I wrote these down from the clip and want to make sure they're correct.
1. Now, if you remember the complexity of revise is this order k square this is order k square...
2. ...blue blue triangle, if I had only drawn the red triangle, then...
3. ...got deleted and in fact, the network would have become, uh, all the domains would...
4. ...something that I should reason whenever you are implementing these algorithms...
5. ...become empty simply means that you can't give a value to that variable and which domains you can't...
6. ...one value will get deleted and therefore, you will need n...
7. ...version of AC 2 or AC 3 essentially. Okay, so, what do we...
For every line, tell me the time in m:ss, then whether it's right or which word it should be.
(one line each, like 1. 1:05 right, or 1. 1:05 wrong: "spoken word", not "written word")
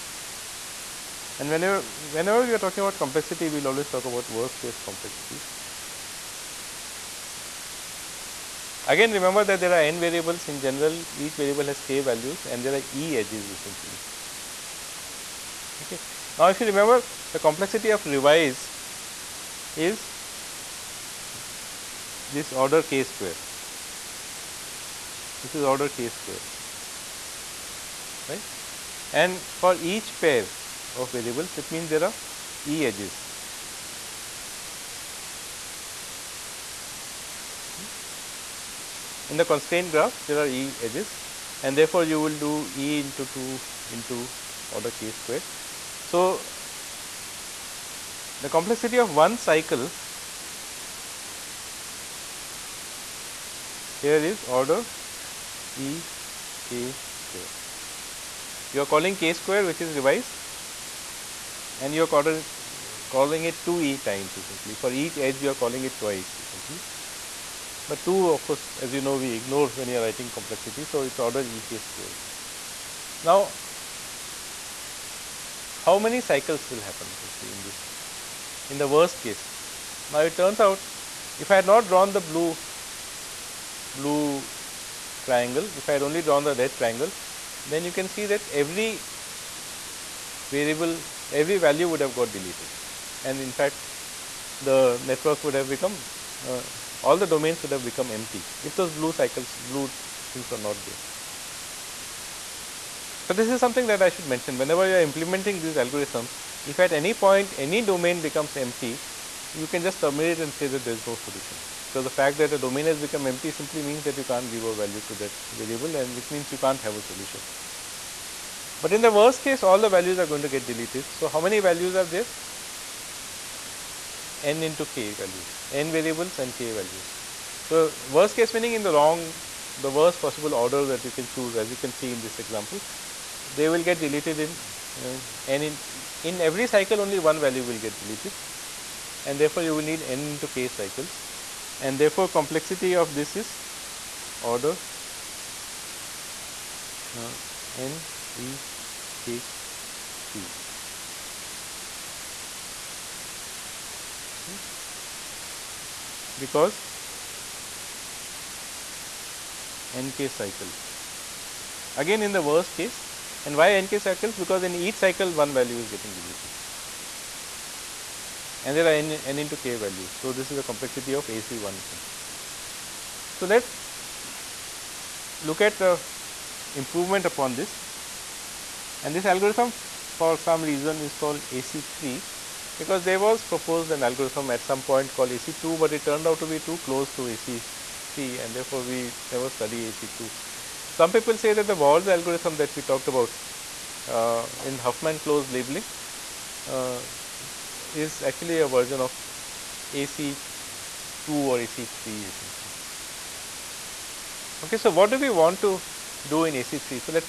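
1. 0:16 right
2. 1:22 right
3. 1:32 right
4. 1:43 wrong: "mention", not "reason"
5. 1:52 wrong: "means", not "domains"
6. 2:17 right
7. 3:18 right.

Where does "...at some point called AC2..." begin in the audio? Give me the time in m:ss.
3:04.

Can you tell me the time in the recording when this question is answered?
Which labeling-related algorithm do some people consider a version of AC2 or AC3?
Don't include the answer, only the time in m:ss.
3:11.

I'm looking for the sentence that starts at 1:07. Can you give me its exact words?
But 2 of course as you know we ignore when you are writing complexity.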